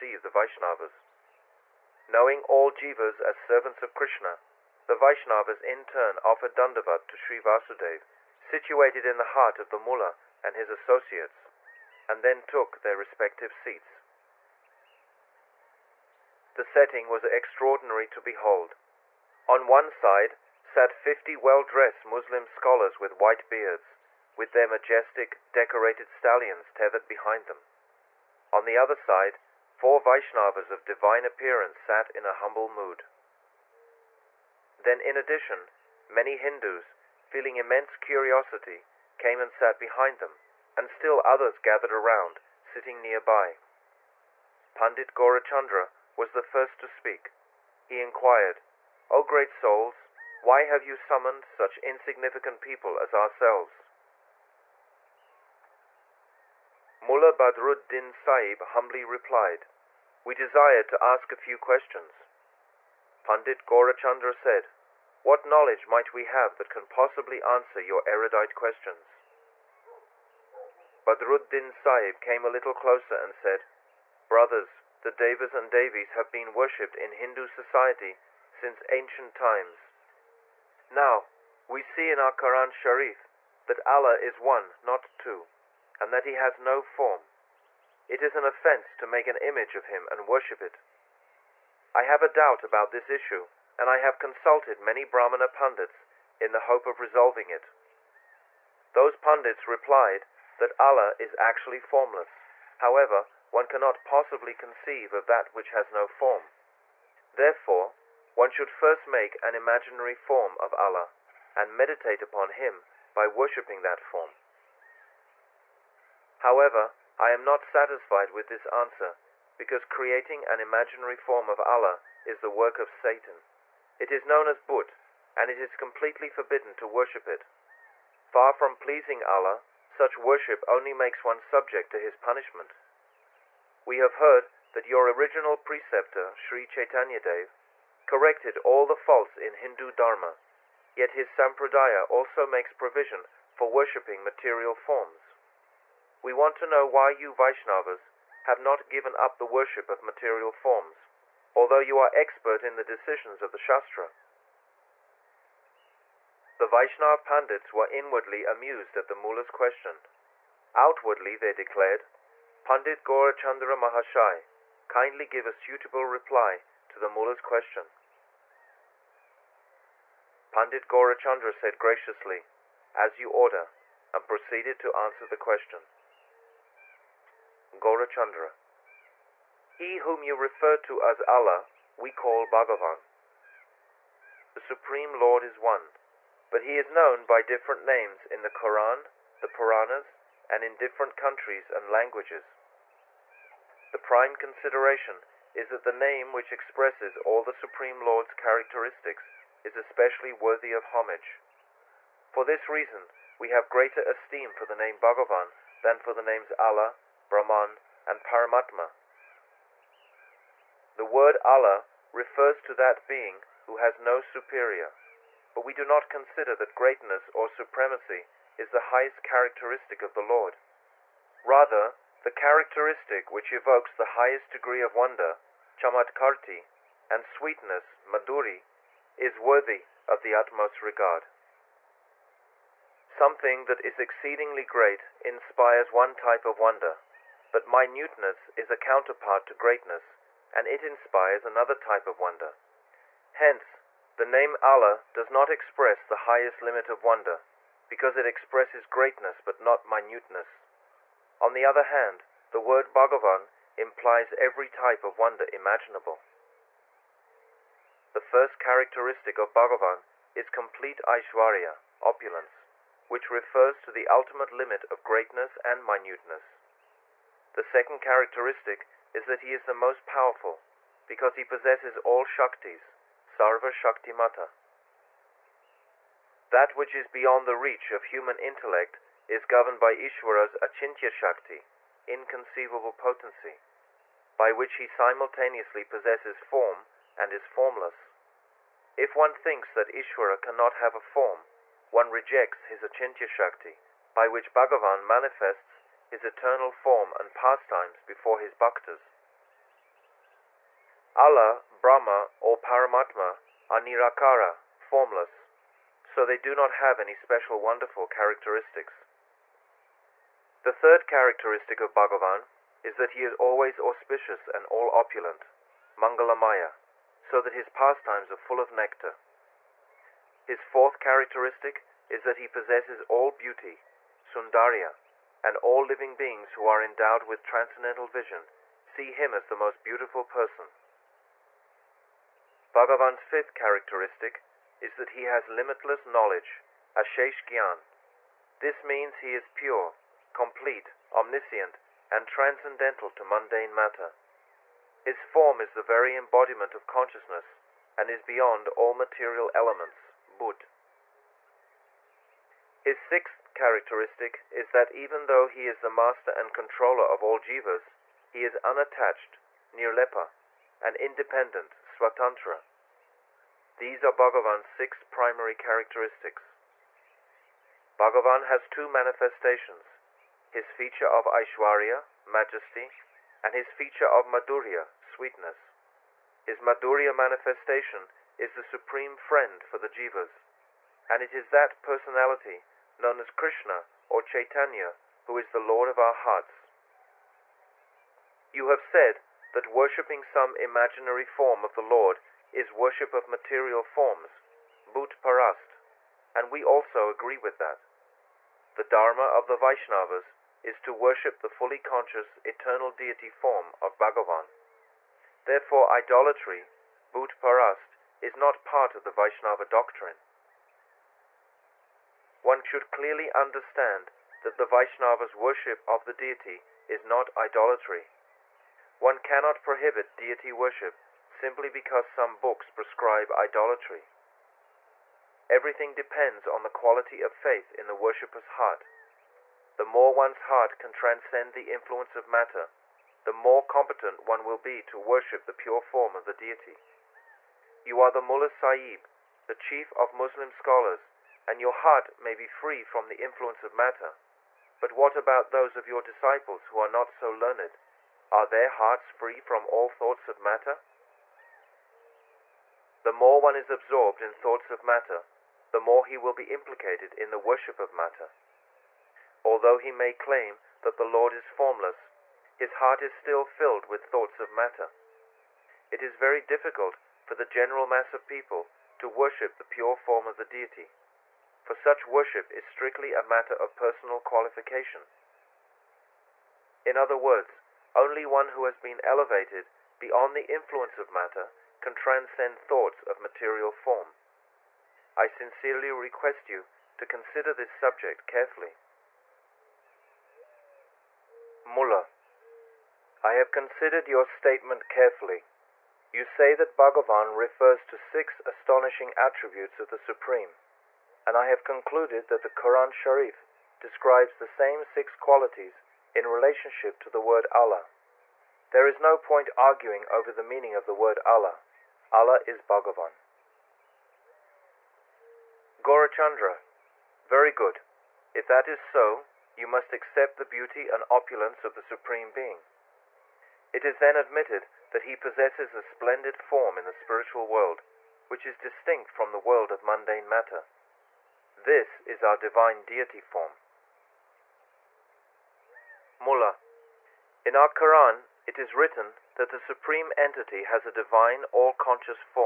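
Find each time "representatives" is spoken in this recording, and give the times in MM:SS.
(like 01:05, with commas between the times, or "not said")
not said.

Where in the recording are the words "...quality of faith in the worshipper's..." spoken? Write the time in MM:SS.
07:06.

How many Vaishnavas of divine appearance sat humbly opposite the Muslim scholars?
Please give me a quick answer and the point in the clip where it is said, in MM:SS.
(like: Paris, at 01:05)
4, at 00:29.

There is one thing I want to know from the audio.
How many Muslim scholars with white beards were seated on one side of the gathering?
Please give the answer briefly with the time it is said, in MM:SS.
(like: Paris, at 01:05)
50, at 00:20.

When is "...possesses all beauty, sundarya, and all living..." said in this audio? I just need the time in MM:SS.
05:22.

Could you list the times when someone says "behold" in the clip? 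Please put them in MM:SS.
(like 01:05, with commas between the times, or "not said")
00:18.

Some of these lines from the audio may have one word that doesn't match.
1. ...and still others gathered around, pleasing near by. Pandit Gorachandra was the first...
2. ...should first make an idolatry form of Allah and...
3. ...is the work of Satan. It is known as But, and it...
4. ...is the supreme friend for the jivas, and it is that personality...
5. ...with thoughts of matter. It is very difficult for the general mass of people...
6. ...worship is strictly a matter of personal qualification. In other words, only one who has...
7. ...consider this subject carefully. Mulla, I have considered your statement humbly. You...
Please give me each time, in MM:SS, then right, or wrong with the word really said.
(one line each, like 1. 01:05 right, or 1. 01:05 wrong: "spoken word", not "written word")
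1. 00:40 wrong: "sitting", not "pleasing"
2. 01:48 wrong: "imaginary", not "idolatry"
3. 02:02 right
4. 06:18 right
5. 07:43 right
6. 07:52 right
7. 08:07 wrong: "carefully", not "humbly".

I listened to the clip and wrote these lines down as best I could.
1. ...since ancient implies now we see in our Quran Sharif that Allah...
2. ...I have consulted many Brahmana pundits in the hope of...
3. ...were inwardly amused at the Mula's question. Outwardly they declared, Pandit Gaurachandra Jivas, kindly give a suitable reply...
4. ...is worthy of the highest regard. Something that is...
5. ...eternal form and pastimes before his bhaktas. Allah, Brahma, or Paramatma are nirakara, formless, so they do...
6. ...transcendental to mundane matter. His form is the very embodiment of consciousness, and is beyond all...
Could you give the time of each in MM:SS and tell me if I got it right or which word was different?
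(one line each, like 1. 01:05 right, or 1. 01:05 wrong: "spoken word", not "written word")
1. 01:18 wrong: "times", not "implies"
2. 01:33 right
3. 02:37 wrong: "Mahashai", not "Jivas"
4. 03:49 wrong: "utmost", not "highest"
5. 04:56 right
6. 05:42 right.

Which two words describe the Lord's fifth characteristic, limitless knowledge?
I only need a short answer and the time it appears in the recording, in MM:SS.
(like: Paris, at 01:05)
ashesh gyan, at 05:36.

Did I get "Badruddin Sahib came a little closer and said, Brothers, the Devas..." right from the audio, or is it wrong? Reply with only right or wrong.
right.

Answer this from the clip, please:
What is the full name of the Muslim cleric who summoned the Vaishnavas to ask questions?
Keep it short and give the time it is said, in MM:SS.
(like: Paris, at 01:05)
Mullah Badruddin Sahib, at 00:56.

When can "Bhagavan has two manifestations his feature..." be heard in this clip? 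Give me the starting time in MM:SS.
06:07.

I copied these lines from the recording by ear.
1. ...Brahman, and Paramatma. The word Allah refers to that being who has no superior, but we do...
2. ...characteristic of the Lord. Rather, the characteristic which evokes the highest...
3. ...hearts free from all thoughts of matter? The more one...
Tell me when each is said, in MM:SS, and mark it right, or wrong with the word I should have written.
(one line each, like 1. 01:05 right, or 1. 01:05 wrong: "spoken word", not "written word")
1. 03:27 right
2. 03:39 right
3. 07:28 right.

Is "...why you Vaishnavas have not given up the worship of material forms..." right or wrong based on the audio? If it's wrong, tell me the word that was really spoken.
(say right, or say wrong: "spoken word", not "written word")
right.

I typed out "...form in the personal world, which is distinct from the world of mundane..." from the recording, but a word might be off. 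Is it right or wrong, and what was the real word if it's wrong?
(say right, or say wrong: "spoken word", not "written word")
wrong: "spiritual", not "personal".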